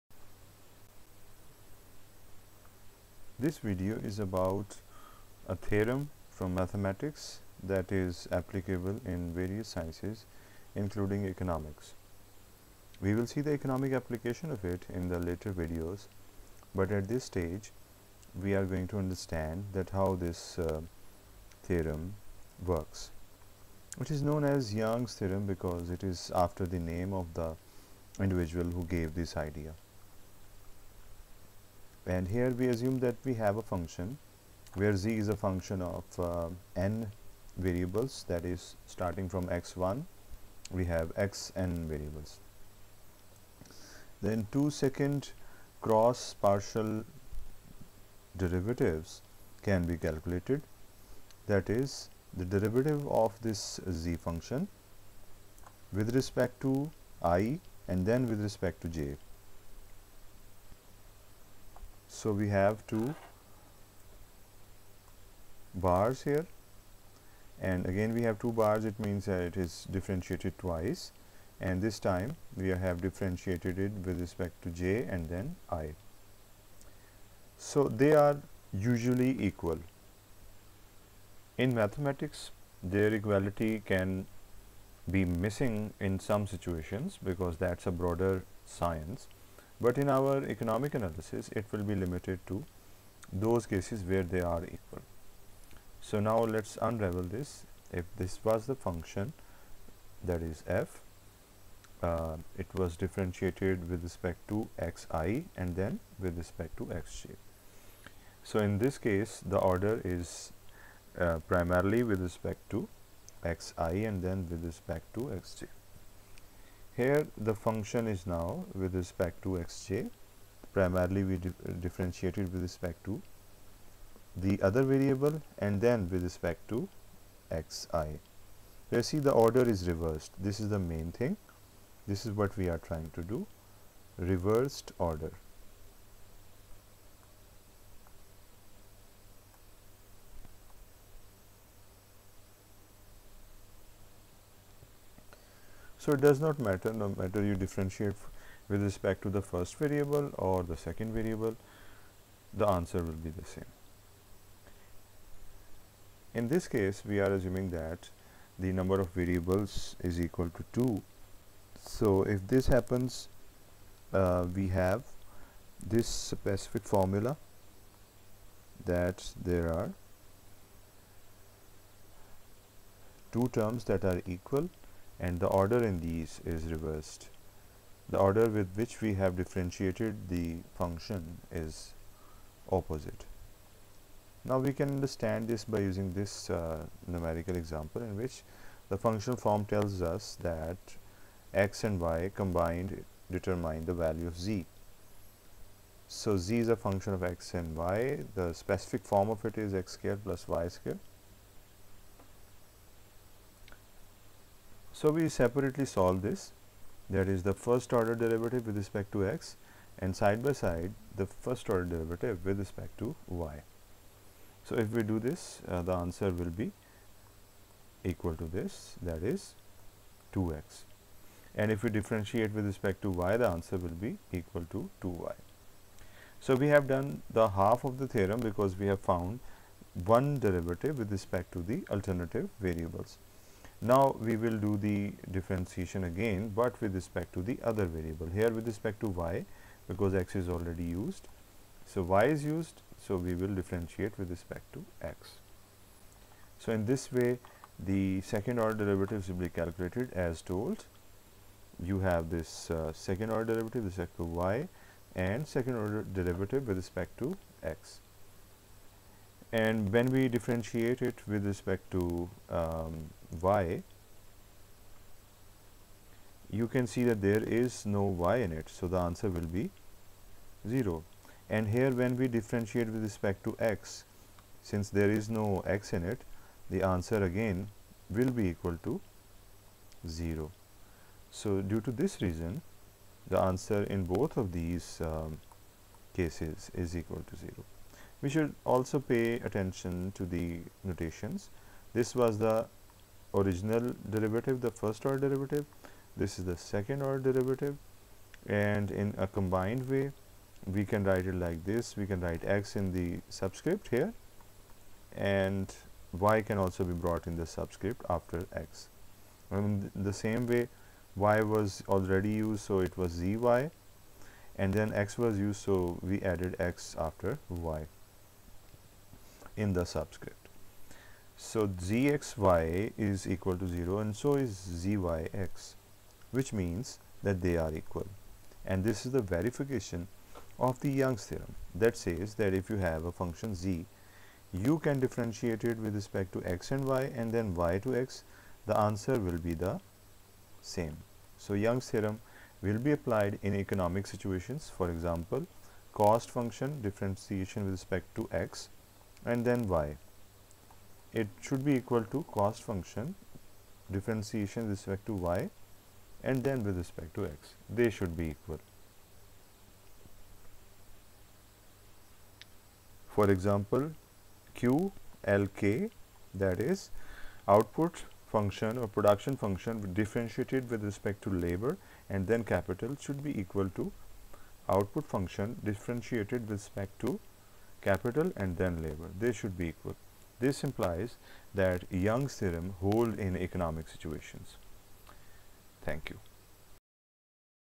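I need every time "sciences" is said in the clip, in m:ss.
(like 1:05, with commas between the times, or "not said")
0:09, 1:28.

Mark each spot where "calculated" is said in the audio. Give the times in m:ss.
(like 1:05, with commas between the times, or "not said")
0:49, 4:09.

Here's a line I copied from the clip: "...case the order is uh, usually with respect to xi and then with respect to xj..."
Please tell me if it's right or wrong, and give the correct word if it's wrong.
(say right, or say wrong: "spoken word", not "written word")
wrong: "primarily", not "usually".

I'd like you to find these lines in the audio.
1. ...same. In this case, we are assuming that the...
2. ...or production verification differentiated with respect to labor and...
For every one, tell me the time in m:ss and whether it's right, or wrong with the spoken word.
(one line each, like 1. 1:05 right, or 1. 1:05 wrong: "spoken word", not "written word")
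1. 2:33 right
2. 6:08 wrong: "function", not "verification".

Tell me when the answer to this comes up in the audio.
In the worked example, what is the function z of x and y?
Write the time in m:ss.
3:19.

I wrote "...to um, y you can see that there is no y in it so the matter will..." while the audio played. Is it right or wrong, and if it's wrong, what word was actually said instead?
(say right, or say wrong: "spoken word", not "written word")
wrong: "answer", not "matter".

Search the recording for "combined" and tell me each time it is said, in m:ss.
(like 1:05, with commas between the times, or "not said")
3:12, 4:59.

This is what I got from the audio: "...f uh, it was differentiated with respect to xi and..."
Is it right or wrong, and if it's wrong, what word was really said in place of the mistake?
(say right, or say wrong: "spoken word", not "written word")
right.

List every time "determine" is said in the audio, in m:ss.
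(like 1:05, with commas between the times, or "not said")
3:13.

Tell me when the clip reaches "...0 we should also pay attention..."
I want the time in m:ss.
4:47.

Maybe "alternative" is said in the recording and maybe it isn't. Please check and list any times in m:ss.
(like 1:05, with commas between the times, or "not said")
3:51.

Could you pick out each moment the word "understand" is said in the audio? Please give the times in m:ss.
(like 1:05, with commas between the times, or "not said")
0:18, 3:04.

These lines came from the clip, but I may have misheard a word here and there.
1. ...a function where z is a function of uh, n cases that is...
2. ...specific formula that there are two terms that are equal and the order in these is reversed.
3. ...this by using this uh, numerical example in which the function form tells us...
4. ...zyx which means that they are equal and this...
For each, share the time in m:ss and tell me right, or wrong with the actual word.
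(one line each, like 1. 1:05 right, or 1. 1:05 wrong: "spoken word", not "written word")
1. 0:33 wrong: "variables", not "cases"
2. 2:46 right
3. 3:05 right
4. 5:24 right.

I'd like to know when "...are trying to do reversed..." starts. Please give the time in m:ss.
2:12.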